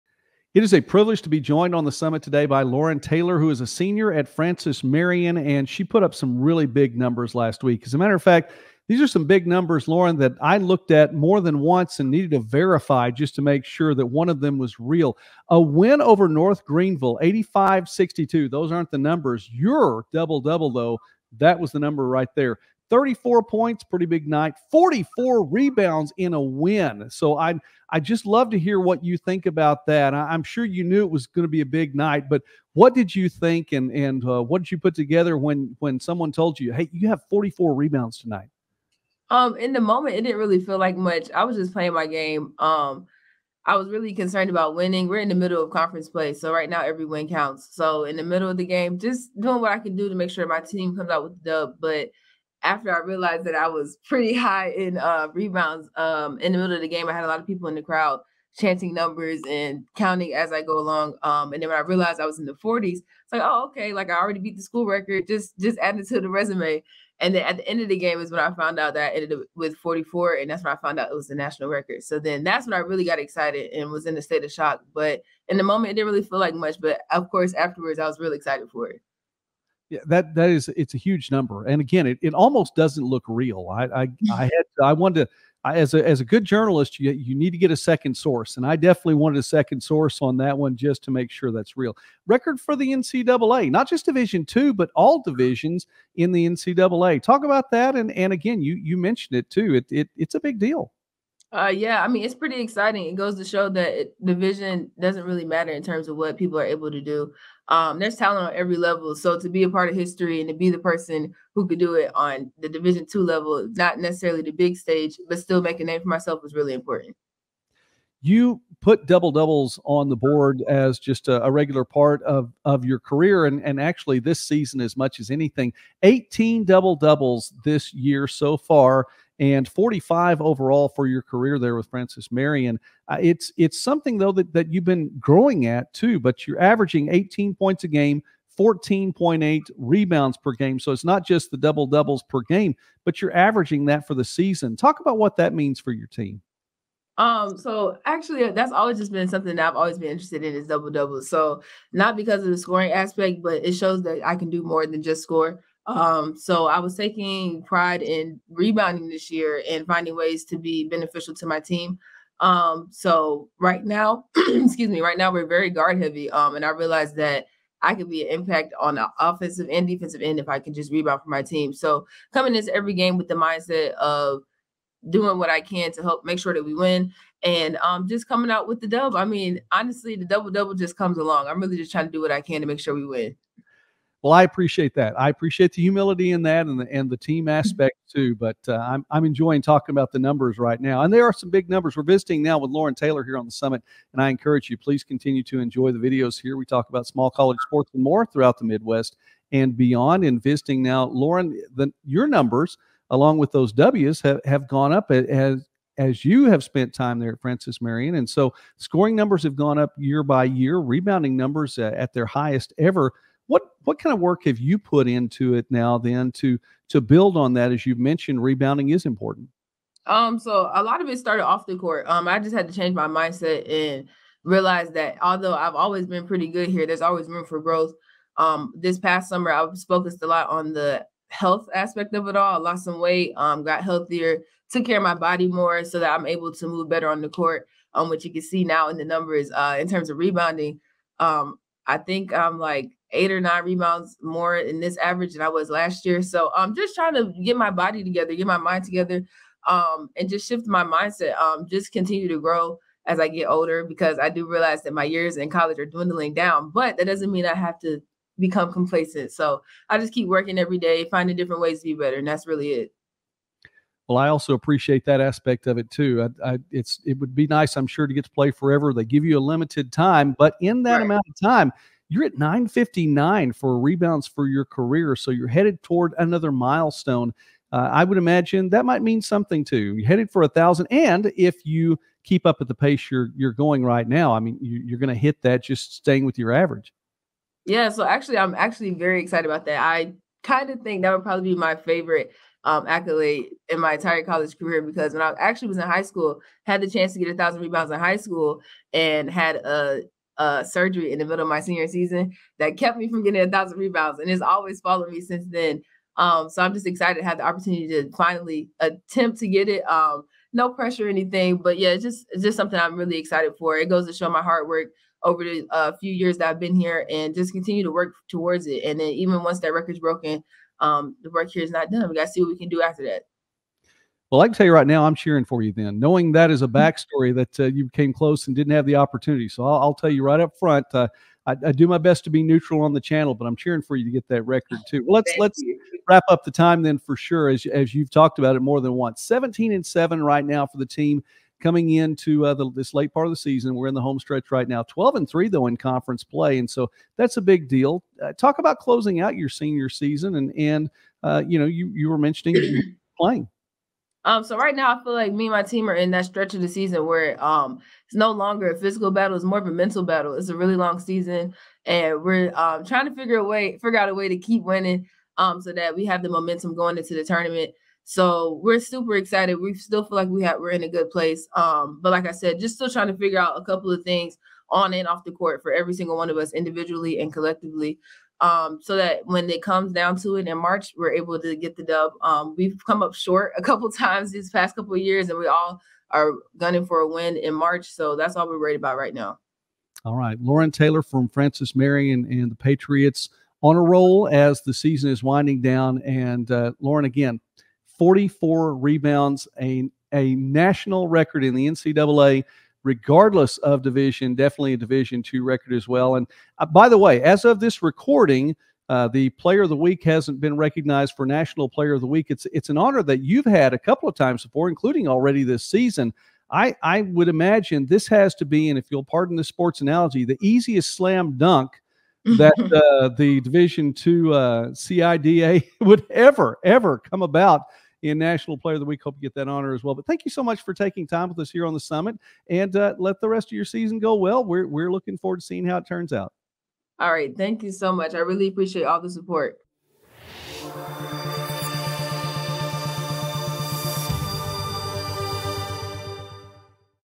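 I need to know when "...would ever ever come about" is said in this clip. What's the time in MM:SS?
07:05.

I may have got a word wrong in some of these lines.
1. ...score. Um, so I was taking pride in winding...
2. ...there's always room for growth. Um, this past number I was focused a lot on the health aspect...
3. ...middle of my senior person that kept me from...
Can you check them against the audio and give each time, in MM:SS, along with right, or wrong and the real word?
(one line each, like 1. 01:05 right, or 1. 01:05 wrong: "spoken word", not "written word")
1. 02:35 wrong: "rebounding", not "winding"
2. 03:46 wrong: "summer", not "number"
3. 05:01 wrong: "season", not "person".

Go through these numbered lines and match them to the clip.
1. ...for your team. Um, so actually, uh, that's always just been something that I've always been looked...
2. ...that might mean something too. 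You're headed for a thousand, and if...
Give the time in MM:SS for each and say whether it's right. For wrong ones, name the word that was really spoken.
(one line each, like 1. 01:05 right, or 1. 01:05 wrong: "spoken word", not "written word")
1. 02:25 wrong: "interested", not "looked"
2. 04:38 right.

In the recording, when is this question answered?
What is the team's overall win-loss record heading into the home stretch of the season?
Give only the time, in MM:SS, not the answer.
05:39.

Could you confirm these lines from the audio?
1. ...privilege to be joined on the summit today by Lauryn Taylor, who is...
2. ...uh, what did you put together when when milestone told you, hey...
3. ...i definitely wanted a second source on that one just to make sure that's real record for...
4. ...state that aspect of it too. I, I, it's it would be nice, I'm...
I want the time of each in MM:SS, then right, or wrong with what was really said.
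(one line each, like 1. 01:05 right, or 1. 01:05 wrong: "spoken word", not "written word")
1. 00:00 right
2. 00:34 wrong: "someone", not "milestone"
3. 01:28 right
4. 04:24 wrong: "appreciate", not "state".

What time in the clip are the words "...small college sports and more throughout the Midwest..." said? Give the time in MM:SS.
03:17.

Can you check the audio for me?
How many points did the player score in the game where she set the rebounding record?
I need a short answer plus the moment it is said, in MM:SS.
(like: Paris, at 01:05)
34, at 00:22.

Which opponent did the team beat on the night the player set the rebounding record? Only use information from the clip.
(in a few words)
North Greenville.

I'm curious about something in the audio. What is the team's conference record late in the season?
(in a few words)
12-3.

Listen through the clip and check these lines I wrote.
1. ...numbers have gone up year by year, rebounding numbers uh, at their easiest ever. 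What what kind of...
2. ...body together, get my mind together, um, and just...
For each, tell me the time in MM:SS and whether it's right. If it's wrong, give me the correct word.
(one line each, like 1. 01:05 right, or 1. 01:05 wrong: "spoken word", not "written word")
1. 03:29 wrong: "highest", not "easiest"
2. 04:07 right.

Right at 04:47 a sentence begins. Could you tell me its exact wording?
Yeah, so actually, I'm actually very excited about that.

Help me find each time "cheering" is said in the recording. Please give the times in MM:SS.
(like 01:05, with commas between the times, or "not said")
05:25, 05:33.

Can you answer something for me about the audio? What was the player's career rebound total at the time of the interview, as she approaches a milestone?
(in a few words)
959.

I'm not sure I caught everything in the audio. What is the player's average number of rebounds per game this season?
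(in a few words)
14.8.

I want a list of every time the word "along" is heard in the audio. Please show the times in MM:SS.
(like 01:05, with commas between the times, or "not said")
01:00, 03:01, 03:23.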